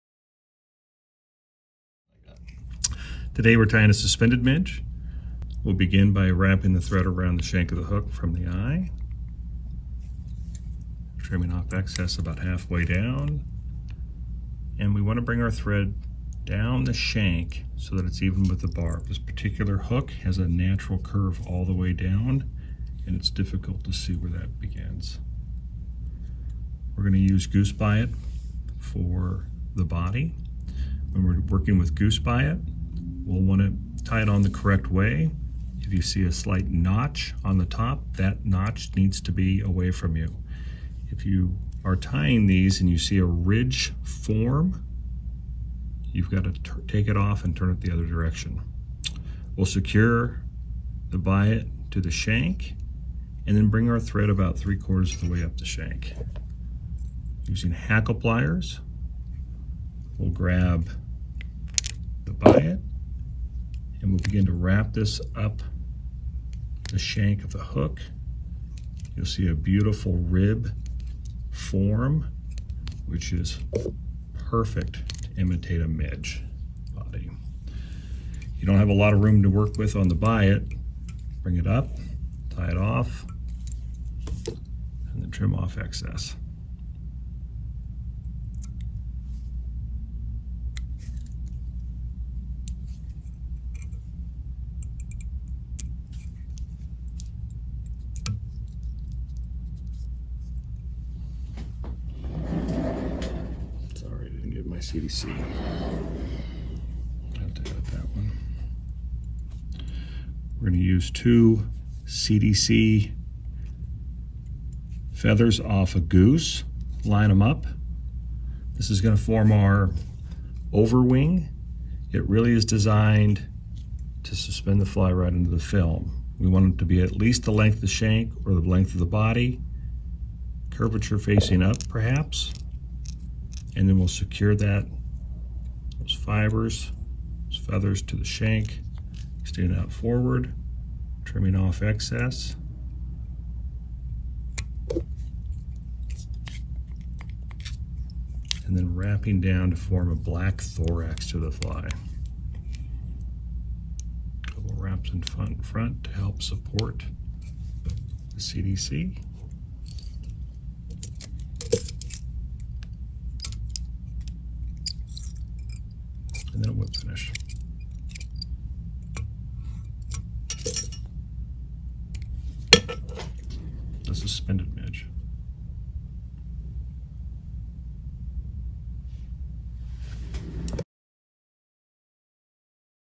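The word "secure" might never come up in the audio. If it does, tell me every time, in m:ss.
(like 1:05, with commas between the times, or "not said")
0:49, 2:14.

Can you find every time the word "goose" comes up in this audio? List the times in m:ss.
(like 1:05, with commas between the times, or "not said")
0:27, 0:31, 1:55.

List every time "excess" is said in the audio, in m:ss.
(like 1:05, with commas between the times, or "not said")
0:11, 1:25, 2:21.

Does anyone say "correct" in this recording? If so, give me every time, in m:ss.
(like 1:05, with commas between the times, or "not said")
0:34.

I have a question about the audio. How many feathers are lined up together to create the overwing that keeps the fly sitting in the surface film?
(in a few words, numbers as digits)
2.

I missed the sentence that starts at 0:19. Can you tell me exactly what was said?
This particular hook has a natural curve all the way down, and it's difficult to see where that begins.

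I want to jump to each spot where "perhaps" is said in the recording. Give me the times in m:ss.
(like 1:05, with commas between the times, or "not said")
2:11.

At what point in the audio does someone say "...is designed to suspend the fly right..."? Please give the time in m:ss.
2:02.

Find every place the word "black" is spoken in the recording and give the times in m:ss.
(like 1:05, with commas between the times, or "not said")
2:30.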